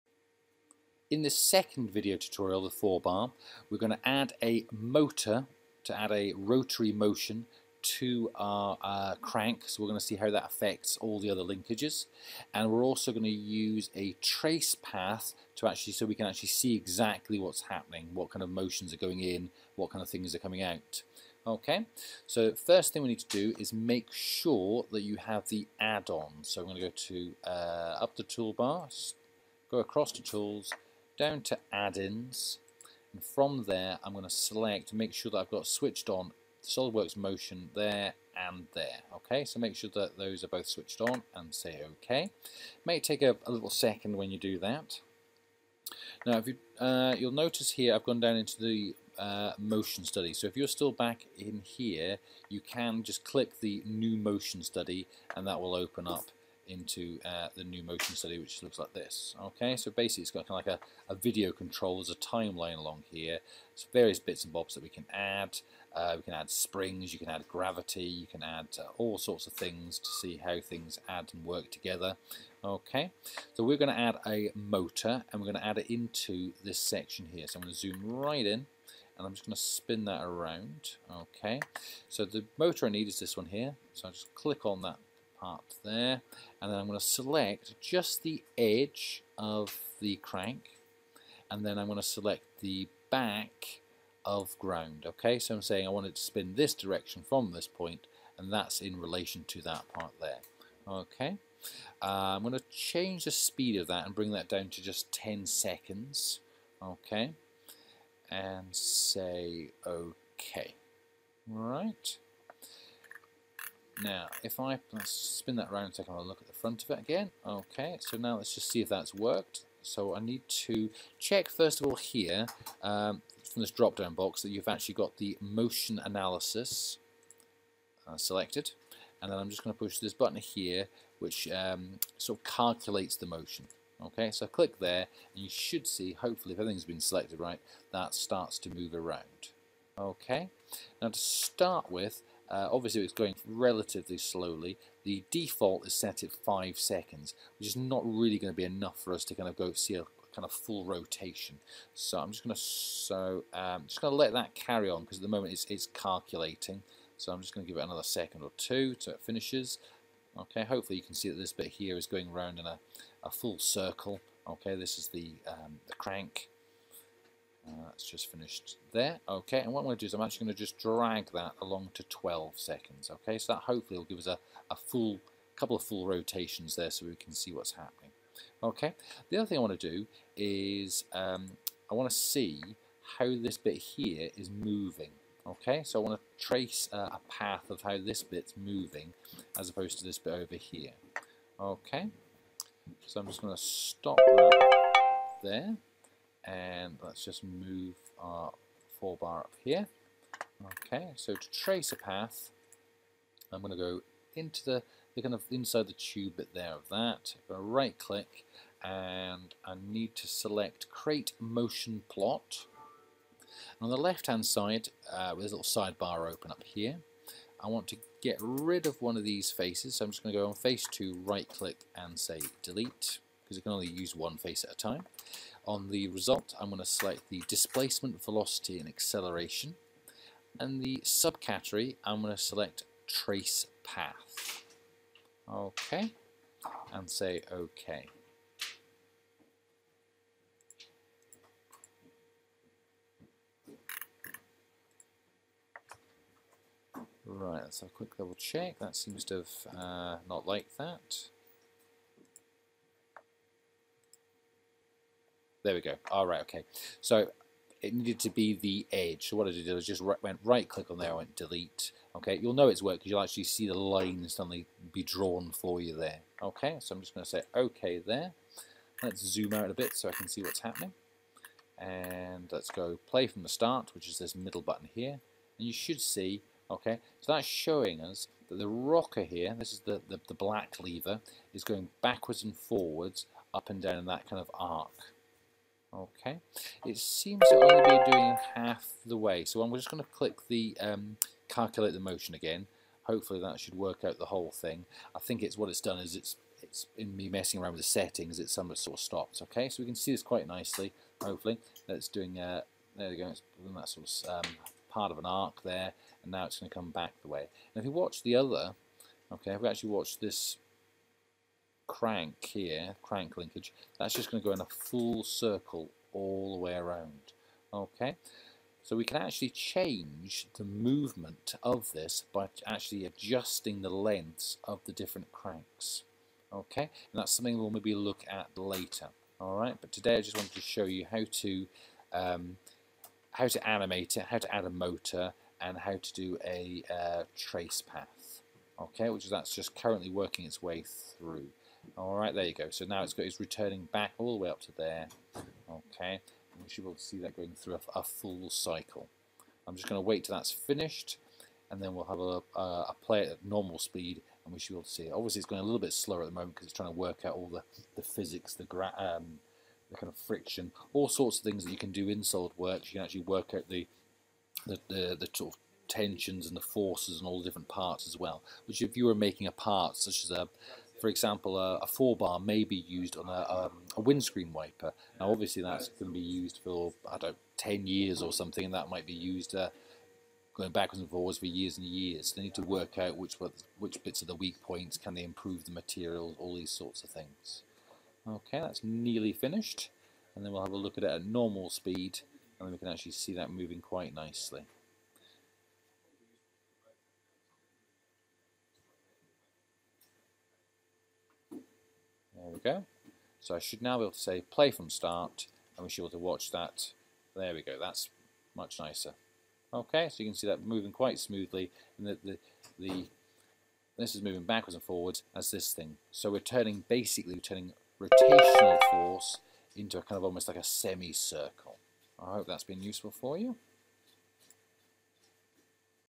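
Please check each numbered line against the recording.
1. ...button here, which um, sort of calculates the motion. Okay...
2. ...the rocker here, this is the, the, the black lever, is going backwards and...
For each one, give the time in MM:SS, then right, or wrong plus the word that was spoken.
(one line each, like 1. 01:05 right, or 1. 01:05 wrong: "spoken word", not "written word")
1. 02:10 right
2. 04:38 right.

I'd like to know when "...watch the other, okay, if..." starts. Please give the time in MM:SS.
05:07.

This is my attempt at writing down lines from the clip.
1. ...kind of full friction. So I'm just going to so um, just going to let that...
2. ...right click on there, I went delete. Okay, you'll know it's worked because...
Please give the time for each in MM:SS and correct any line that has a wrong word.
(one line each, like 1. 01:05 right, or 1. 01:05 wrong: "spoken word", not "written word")
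1. 02:30 wrong: "rotation", not "friction"
2. 04:20 right.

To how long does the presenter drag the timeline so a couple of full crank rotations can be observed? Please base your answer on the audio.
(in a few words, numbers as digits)
12 seconds.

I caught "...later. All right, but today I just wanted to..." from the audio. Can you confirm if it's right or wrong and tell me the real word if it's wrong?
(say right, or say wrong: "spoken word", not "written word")
right.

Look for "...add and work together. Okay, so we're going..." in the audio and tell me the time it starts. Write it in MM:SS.
01:11.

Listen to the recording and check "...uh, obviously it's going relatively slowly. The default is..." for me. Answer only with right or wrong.
right.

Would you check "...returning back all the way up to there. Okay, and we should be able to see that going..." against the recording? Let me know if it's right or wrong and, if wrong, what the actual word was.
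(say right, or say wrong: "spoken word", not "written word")
right.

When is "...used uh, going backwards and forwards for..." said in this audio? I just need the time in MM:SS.
06:19.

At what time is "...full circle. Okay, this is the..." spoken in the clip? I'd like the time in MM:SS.
02:43.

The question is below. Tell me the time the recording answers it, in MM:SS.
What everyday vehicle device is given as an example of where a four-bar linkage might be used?
06:14.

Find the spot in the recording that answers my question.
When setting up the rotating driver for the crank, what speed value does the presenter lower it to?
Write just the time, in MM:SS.
01:45.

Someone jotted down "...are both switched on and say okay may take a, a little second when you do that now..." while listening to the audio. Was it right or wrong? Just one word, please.
right.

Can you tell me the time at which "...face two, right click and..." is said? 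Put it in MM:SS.
03:40.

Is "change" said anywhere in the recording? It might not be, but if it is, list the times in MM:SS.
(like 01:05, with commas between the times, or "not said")
01:42, 05:19.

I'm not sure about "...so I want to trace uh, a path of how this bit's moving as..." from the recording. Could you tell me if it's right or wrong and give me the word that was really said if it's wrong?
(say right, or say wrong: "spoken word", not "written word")
right.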